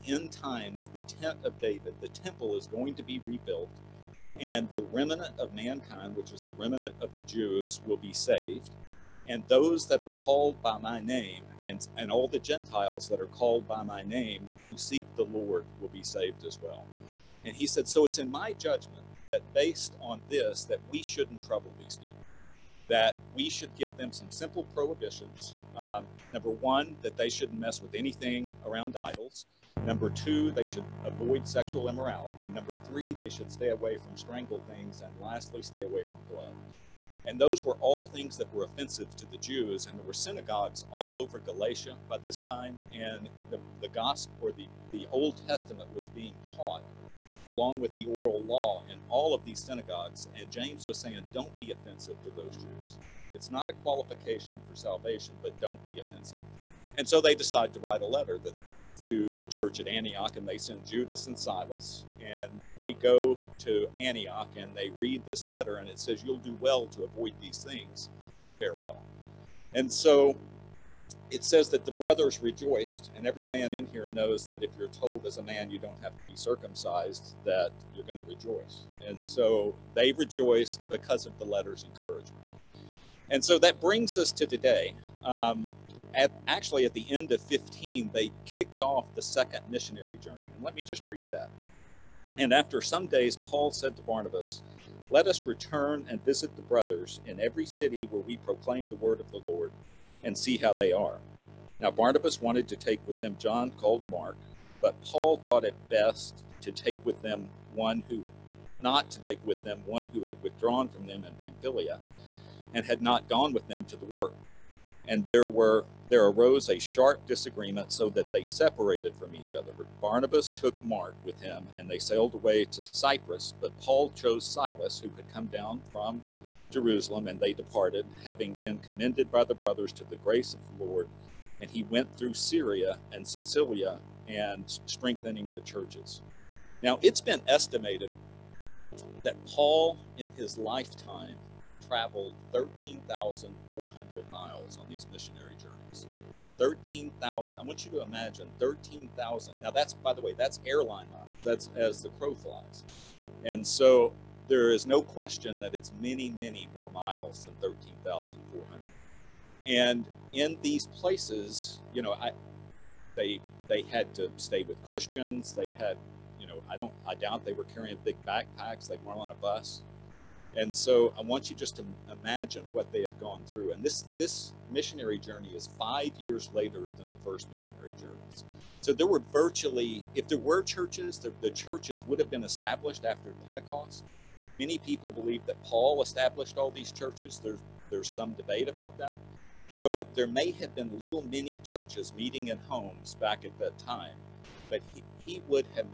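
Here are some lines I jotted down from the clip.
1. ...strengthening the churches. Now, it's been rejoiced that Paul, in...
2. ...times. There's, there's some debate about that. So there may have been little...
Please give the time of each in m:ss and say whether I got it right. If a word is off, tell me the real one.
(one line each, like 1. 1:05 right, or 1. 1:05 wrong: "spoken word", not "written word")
1. 2:14 wrong: "estimated", not "rejoiced"
2. 3:06 wrong: "churches", not "times".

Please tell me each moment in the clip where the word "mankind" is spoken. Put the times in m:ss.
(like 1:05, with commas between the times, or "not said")
0:05.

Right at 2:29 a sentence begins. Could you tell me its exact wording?
Now, that's, by the way, that's airline miles.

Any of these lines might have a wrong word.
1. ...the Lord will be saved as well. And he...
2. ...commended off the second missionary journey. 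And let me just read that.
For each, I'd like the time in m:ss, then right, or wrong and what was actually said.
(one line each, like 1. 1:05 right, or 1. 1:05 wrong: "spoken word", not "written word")
1. 0:15 right
2. 1:28 wrong: "kicked", not "commended".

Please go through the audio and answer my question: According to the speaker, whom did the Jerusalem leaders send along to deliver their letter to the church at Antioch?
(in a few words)
Judas and Silas.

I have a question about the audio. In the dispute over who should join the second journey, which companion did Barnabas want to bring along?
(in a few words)
John called Mark.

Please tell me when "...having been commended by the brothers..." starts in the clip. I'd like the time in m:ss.
2:08.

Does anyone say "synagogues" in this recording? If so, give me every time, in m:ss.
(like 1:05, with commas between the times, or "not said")
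0:40, 0:49.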